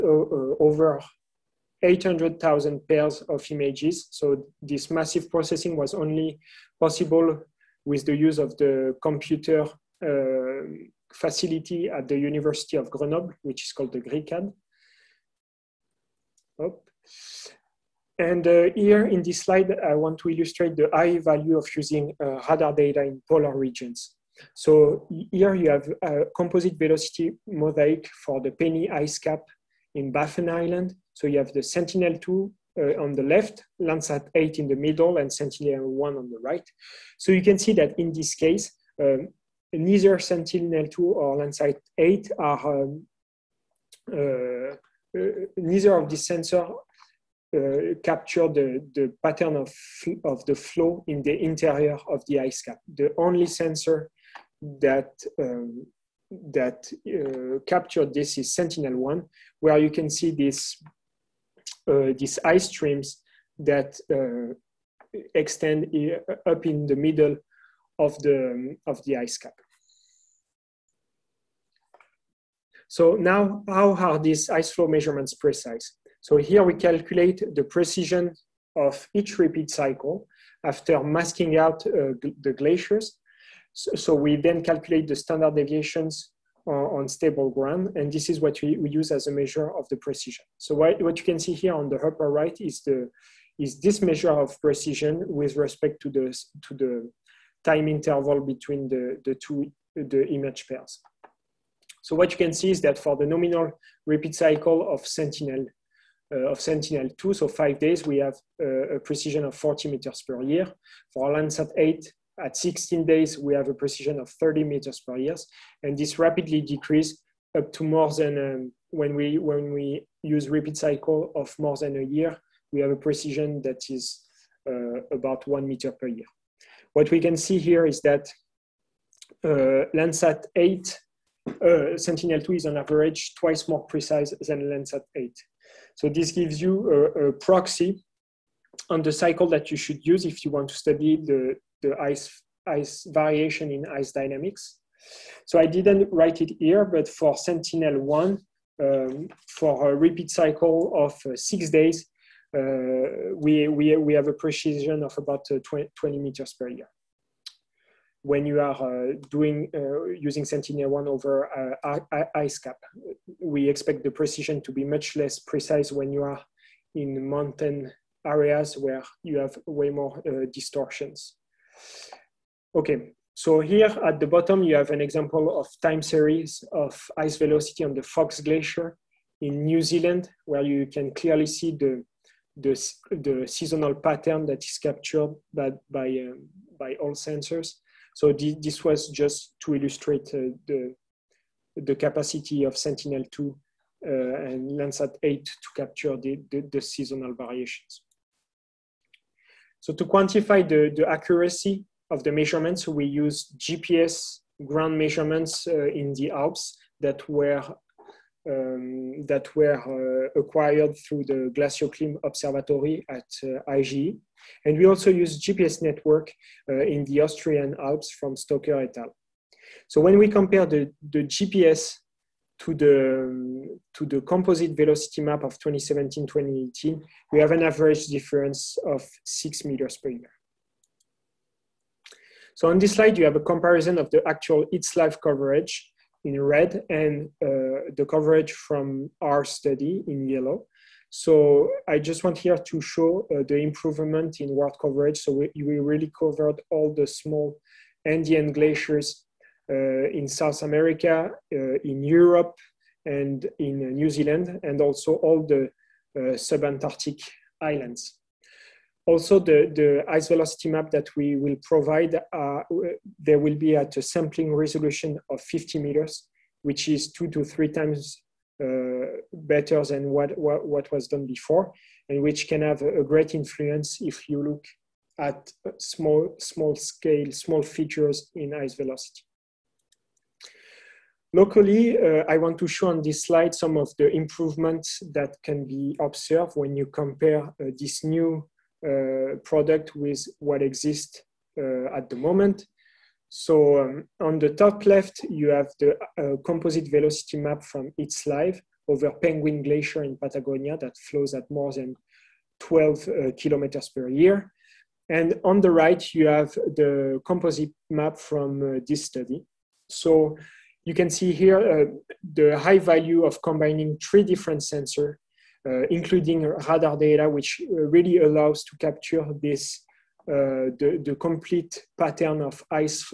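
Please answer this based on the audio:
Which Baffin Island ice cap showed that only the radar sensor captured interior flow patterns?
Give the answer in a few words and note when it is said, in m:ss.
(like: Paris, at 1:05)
Penny ice cap, at 0:28.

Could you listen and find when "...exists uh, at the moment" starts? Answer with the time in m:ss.
4:50.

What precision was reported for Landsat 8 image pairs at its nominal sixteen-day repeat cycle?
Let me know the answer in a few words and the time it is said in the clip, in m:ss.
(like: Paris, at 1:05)
30 meters per year, at 1:54.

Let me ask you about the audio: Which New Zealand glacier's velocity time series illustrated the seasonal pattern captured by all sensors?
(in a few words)
Fox Glacier.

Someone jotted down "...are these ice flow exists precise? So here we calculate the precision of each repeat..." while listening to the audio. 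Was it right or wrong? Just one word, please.
wrong.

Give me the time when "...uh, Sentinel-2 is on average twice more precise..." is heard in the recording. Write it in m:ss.
2:11.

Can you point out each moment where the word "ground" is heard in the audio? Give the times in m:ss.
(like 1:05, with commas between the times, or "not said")
1:27, 3:24.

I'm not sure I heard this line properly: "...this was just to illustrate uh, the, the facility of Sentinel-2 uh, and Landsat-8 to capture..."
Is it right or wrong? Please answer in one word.
wrong.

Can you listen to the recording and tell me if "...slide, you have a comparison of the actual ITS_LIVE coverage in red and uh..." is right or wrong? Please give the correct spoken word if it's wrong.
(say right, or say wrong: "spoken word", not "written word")
right.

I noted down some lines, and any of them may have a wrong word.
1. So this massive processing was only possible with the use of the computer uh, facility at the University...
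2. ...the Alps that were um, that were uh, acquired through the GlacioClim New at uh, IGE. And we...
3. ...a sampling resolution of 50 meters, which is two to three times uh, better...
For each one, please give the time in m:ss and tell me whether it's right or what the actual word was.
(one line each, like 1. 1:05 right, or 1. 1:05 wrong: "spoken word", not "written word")
1. 0:04 right
2. 3:26 wrong: "Observatory", not "New"
3. 4:23 right.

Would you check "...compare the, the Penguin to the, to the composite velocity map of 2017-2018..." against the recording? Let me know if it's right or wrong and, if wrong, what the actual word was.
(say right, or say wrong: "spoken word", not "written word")
wrong: "GPS", not "Penguin".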